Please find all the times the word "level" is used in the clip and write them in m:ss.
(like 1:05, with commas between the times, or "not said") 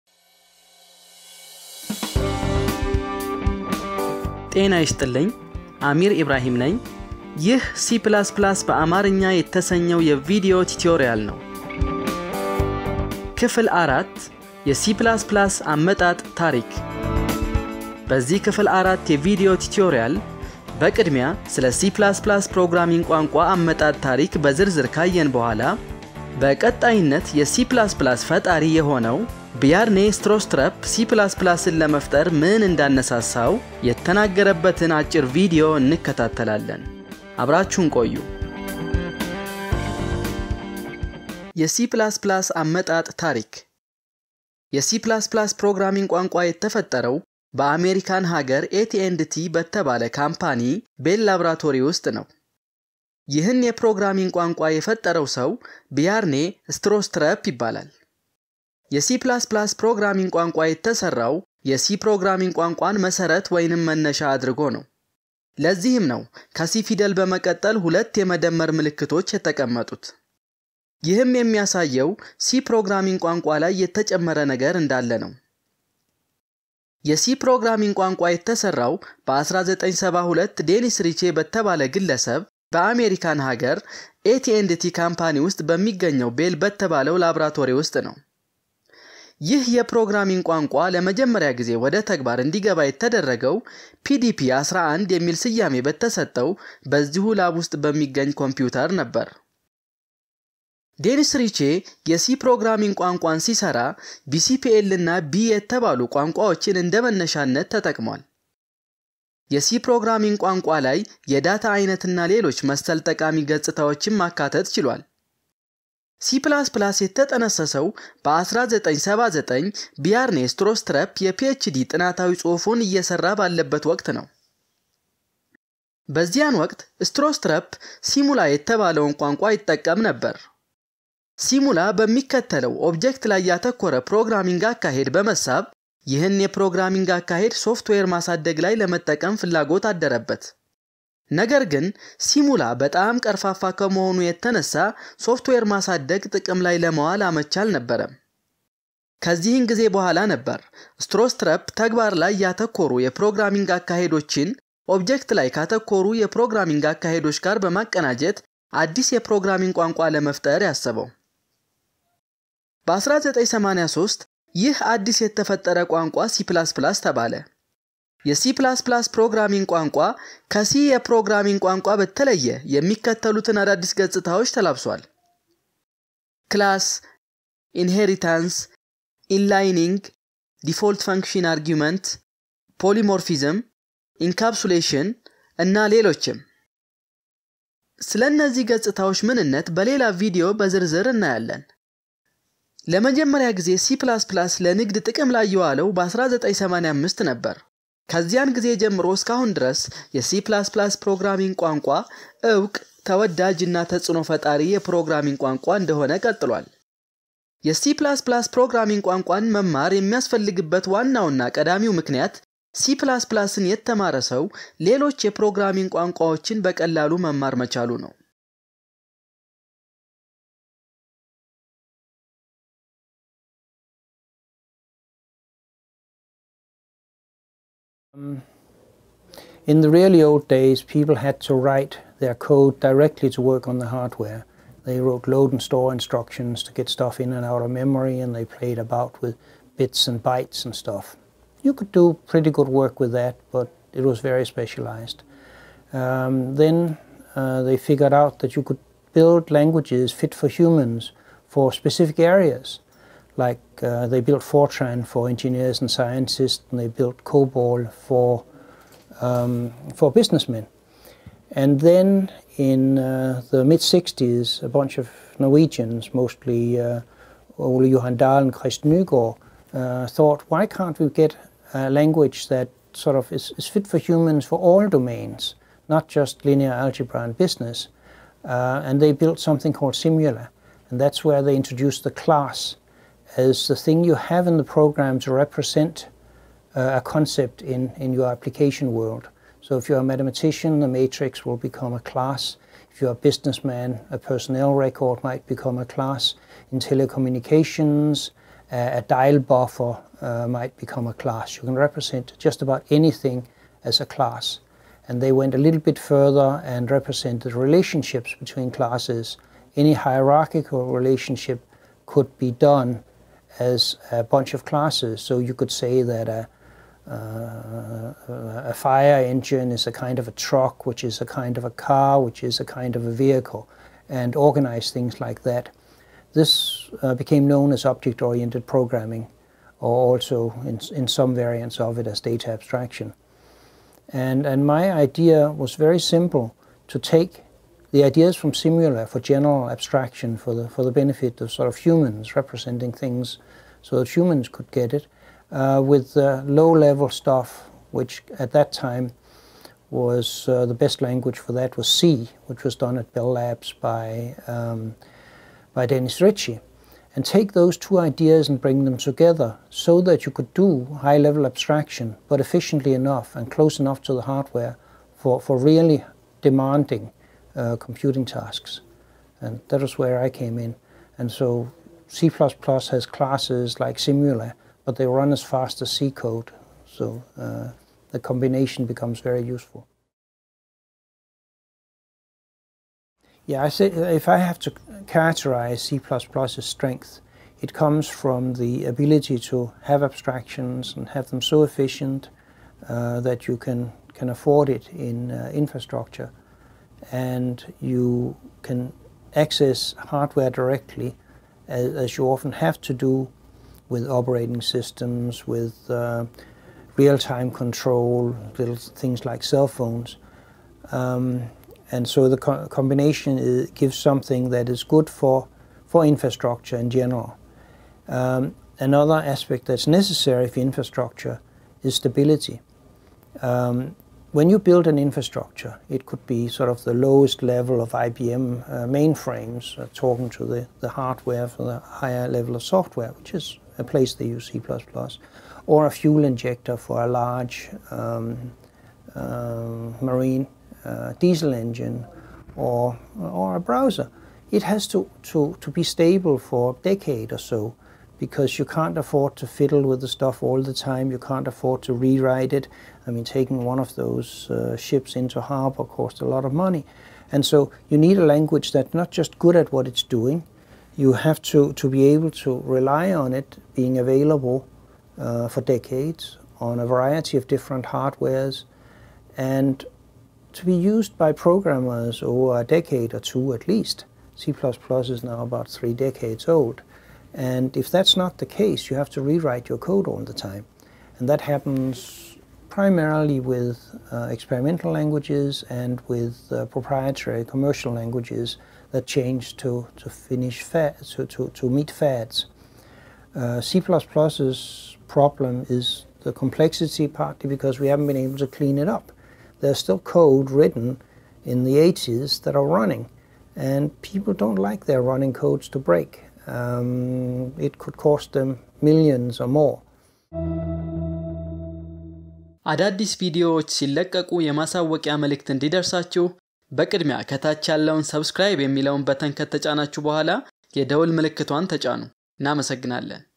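5:46, 6:01, 7:07, 7:12.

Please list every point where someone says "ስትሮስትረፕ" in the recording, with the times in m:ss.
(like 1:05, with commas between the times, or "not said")
0:30, 0:56, 2:00, 2:07, 2:31.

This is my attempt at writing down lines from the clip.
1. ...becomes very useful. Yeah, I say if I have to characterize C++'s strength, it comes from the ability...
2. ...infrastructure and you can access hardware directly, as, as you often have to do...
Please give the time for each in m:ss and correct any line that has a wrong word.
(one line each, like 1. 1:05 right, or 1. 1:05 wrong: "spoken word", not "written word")
1. 6:18 right
2. 6:35 right.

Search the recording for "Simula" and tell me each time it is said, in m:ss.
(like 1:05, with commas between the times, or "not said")
4:39, 5:38, 6:13.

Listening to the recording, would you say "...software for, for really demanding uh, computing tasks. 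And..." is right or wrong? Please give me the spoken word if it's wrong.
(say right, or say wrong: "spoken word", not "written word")
wrong: "hardware", not "software".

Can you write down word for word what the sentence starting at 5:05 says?
And they went a little bit further and represented relationships between classes.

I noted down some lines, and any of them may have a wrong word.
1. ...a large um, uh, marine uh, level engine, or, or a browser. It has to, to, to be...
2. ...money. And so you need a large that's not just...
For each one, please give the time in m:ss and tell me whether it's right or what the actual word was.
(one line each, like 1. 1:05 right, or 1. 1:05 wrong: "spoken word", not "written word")
1. 7:17 wrong: "diesel", not "level"
2. 7:36 wrong: "language", not "large".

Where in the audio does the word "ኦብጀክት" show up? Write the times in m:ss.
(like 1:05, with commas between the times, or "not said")
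2:12, 2:34.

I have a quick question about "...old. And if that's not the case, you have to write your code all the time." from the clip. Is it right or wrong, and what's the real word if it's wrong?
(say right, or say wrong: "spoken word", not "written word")
wrong: "rewrite", not "write".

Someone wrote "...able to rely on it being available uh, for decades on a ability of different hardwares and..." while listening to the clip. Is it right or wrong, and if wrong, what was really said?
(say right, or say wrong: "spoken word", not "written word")
wrong: "variety", not "ability".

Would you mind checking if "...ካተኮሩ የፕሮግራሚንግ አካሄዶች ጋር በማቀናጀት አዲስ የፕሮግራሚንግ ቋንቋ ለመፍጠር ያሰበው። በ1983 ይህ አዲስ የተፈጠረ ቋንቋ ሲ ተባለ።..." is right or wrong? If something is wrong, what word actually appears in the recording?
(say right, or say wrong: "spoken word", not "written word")
right.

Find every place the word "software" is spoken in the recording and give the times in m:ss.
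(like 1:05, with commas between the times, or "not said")
7:12.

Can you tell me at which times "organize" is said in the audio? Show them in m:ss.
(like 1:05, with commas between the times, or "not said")
5:24.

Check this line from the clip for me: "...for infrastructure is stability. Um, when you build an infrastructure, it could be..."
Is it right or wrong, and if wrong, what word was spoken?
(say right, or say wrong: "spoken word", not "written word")
right.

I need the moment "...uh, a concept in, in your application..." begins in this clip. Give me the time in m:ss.
4:46.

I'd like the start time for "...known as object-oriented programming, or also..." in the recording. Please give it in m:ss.
5:27.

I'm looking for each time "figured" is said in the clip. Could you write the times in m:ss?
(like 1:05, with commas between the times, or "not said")
4:07.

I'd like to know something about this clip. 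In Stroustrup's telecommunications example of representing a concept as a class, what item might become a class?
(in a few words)
a dial buffer.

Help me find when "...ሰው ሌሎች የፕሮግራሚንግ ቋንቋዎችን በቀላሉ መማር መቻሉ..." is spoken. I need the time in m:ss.
3:34.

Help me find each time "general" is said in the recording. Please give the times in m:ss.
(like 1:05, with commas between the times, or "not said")
5:39, 6:56.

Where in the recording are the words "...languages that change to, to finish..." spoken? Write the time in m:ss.
8:07.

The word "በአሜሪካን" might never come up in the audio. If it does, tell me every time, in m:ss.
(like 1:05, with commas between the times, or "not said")
0:47, 1:22.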